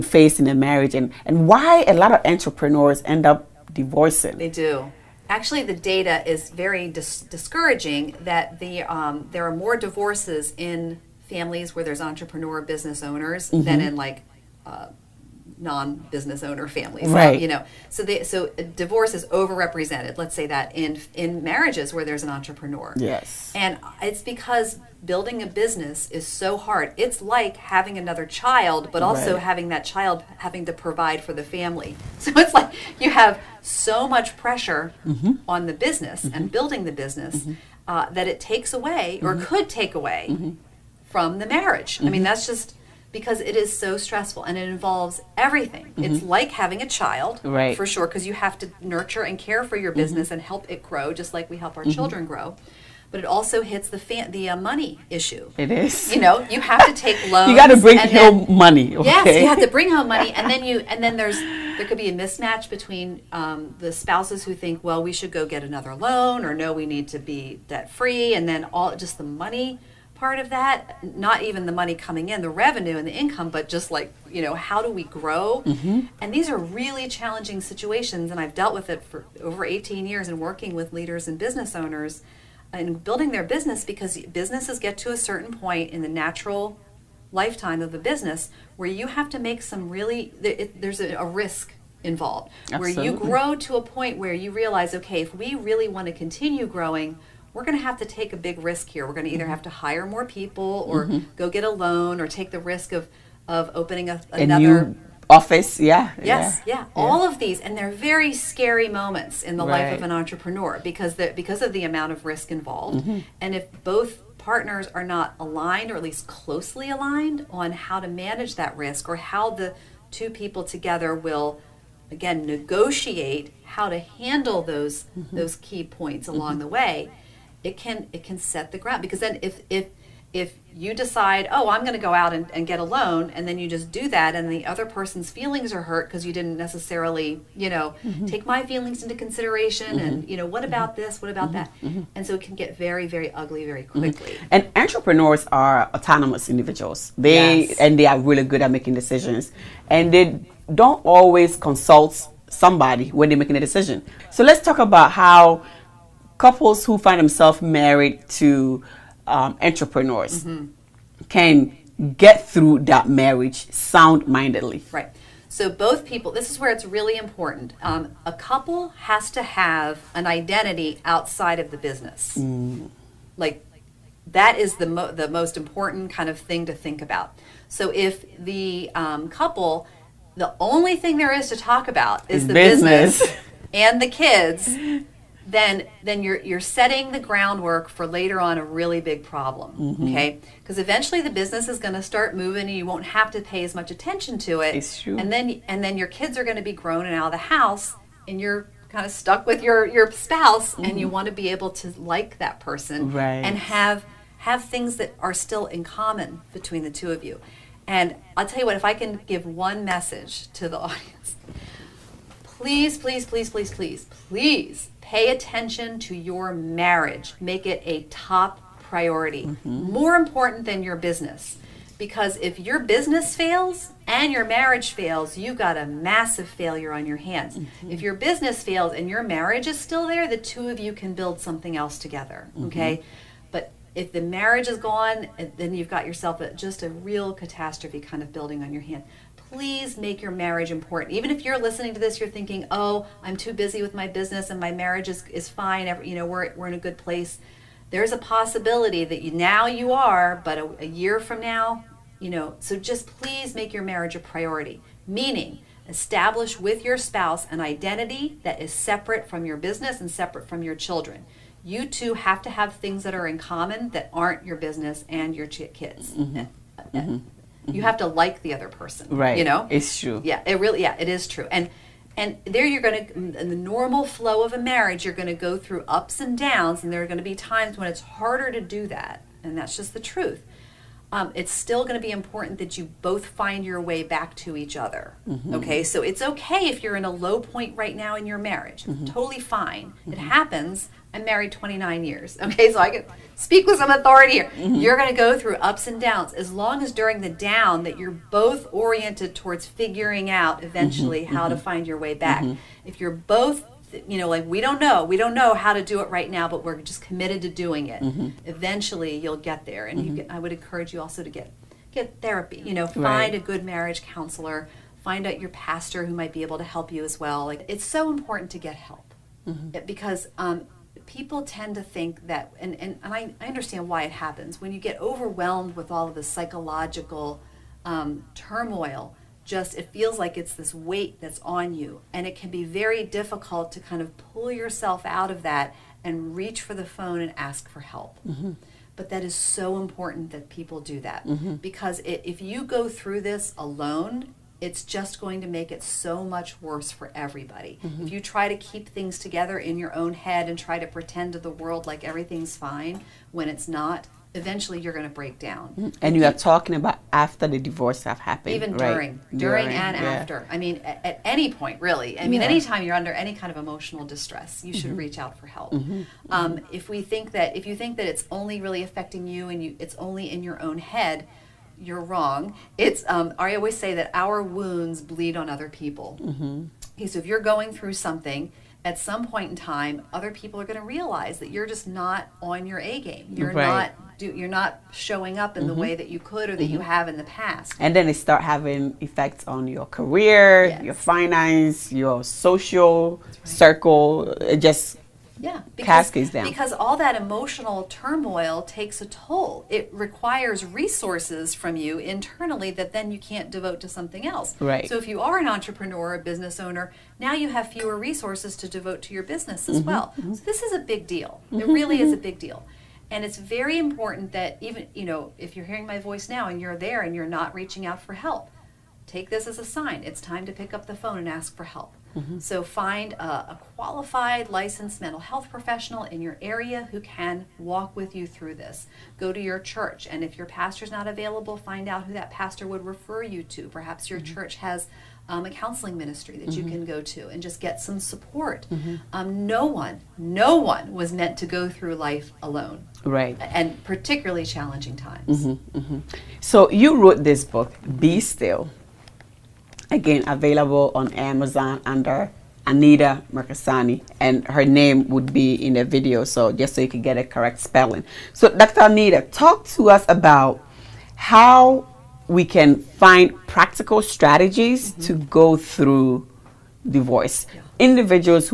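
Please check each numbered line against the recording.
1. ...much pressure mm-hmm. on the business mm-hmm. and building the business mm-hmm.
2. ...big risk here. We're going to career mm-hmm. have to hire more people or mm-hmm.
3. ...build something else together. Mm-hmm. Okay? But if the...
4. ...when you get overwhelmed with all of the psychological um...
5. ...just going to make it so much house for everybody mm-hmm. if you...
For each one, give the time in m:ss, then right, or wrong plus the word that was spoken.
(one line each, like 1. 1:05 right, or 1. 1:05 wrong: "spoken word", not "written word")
1. 0:34 right
2. 1:38 wrong: "either", not "career"
3. 3:51 right
4. 5:24 right
5. 5:44 wrong: "worse", not "house".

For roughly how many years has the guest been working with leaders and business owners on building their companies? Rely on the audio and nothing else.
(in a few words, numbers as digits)
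18 years.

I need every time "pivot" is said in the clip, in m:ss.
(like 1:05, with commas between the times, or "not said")
not said.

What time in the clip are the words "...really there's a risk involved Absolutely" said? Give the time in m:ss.
1:29.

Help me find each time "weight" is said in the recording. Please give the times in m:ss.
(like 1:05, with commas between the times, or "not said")
5:30.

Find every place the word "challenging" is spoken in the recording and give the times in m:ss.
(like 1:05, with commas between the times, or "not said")
1:17, 7:24.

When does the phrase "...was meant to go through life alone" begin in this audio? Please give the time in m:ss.
7:20.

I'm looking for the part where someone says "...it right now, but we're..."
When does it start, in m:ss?
5:05.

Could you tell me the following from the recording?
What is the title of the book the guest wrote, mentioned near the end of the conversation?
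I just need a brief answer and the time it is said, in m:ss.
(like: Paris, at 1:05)
Be Still, at 7:27.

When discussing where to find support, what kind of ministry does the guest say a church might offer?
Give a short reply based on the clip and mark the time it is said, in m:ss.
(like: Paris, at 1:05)
counseling ministry, at 7:15.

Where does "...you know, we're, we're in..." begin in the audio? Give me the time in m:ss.
4:06.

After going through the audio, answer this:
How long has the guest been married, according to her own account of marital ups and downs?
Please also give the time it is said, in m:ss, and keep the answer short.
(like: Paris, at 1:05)
29 years, at 4:51.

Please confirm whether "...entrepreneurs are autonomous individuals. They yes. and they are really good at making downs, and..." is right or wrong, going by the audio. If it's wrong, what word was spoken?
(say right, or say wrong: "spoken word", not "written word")
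wrong: "decisions", not "downs".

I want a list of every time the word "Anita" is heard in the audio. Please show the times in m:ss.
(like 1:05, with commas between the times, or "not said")
7:32, 7:38.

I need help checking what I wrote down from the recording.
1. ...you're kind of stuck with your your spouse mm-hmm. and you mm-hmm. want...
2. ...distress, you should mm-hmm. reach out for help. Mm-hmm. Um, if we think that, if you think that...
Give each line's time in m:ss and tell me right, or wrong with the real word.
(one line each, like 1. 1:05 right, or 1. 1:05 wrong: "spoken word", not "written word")
1. 3:18 right
2. 6:04 right.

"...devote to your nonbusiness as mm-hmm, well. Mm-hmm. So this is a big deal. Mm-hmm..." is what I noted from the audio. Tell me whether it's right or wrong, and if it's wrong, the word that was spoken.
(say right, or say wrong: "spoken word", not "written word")
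wrong: "business", not "nonbusiness".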